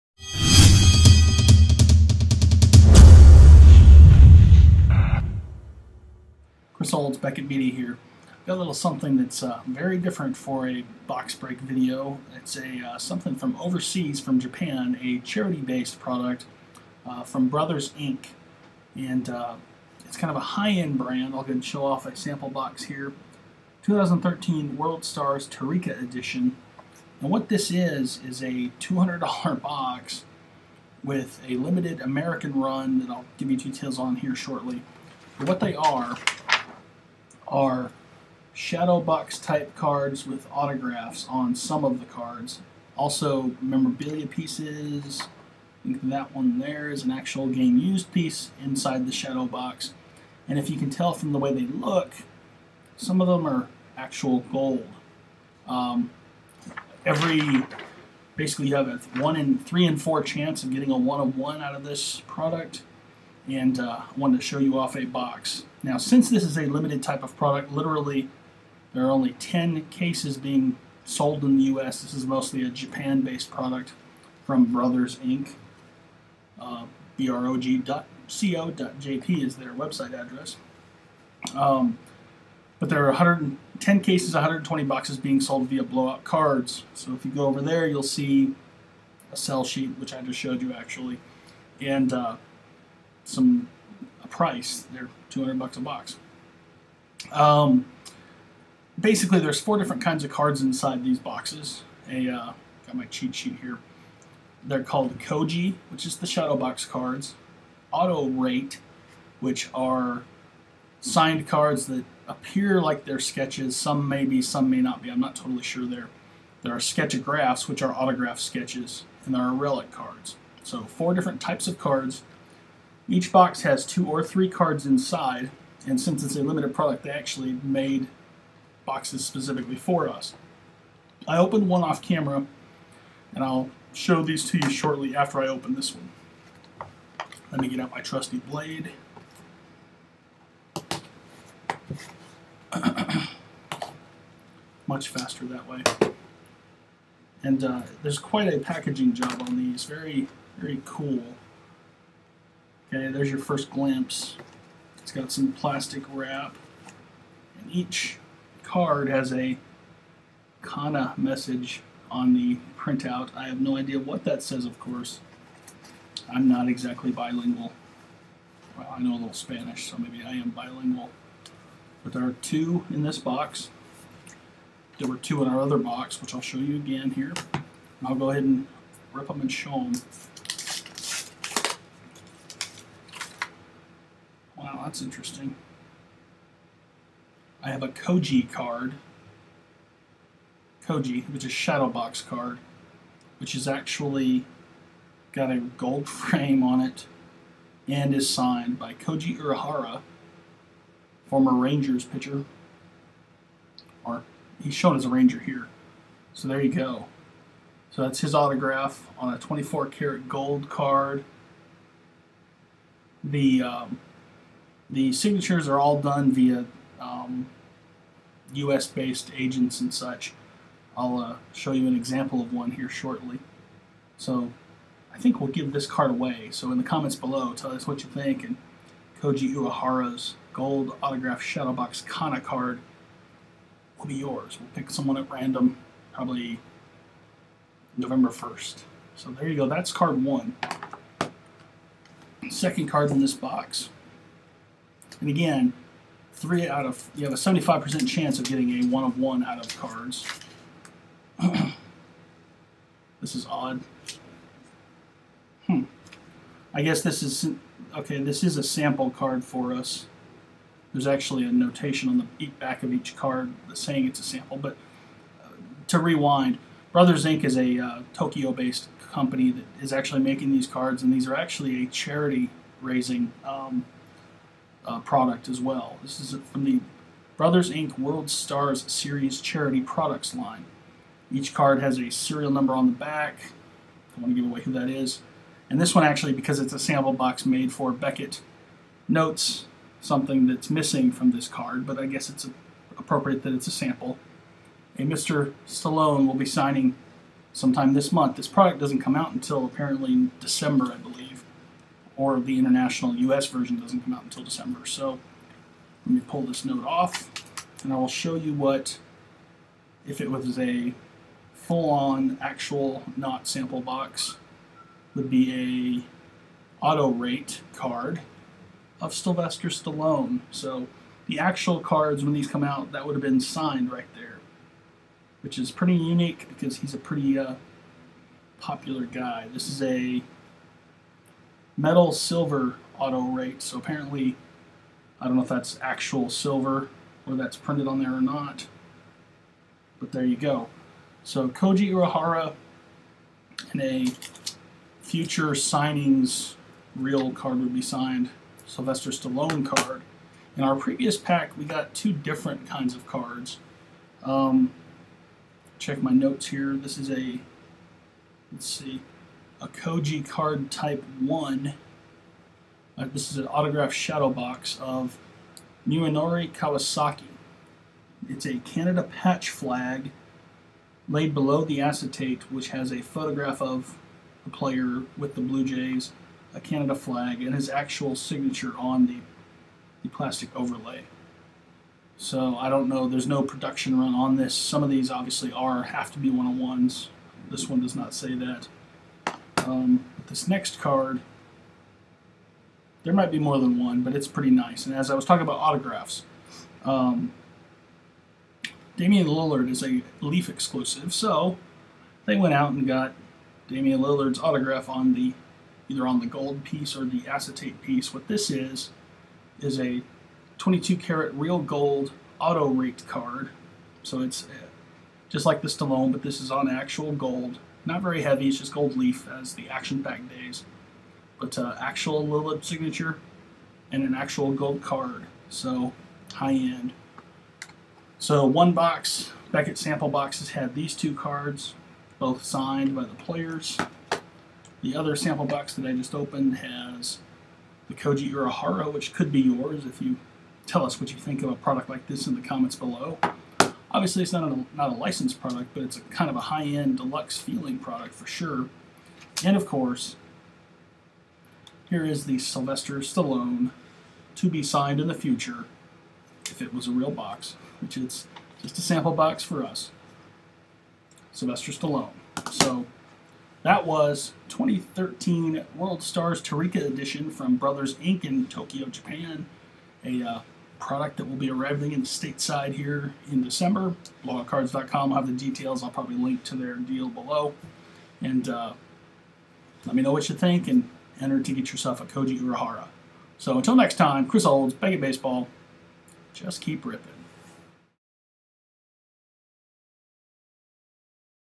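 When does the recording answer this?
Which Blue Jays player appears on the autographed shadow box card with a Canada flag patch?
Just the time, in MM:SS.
06:05.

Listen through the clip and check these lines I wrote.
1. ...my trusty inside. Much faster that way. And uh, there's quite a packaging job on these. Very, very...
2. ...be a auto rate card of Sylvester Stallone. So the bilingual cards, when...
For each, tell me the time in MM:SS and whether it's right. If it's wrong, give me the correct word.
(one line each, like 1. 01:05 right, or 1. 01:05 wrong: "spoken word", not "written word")
1. 02:17 wrong: "blade", not "inside"
2. 05:15 wrong: "actual", not "bilingual".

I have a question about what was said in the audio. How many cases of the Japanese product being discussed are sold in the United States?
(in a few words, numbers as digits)
10.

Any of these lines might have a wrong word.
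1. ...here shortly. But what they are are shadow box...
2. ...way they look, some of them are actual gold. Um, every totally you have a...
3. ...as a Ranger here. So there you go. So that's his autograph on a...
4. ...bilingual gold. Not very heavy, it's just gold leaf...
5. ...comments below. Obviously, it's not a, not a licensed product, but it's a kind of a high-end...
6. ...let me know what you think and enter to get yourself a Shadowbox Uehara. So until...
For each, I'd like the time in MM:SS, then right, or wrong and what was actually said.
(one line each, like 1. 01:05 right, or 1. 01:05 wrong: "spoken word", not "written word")
1. 00:34 right
2. 00:51 wrong: "basically", not "totally"
3. 03:24 right
4. 06:56 wrong: "actual", not "bilingual"
5. 07:22 right
6. 07:59 wrong: "Koji", not "Shadowbox".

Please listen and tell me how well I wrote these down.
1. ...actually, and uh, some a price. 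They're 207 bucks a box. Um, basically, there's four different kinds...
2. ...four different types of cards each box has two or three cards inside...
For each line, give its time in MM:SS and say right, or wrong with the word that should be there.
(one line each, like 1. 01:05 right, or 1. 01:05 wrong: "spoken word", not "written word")
1. 01:30 wrong: "200", not "207"
2. 02:00 right.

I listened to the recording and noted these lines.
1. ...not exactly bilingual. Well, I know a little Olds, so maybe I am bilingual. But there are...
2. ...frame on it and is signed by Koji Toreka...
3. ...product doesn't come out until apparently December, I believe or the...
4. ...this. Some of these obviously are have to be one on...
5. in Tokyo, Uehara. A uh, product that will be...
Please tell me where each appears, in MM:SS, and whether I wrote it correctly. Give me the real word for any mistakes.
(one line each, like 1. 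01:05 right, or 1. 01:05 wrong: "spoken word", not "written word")
1. 02:46 wrong: "Spanish", not "Olds"
2. 03:16 wrong: "Uehara", not "Toreka"
3. 04:58 right
4. 06:24 right
5. 07:48 wrong: "Japan", not "Uehara".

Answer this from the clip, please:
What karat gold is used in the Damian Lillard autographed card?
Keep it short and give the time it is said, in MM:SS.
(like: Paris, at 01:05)
22 karat, at 06:50.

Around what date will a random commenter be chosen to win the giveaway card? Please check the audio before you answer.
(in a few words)
November 1st.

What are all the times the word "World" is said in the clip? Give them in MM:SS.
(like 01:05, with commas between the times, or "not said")
00:24, 04:37, 07:45.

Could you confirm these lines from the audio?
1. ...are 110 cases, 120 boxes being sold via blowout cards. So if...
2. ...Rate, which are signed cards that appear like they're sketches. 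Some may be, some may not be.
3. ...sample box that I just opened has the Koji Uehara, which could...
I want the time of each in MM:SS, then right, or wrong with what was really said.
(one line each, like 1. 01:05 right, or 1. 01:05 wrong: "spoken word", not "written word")
1. 01:23 right
2. 01:48 right
3. 07:15 right.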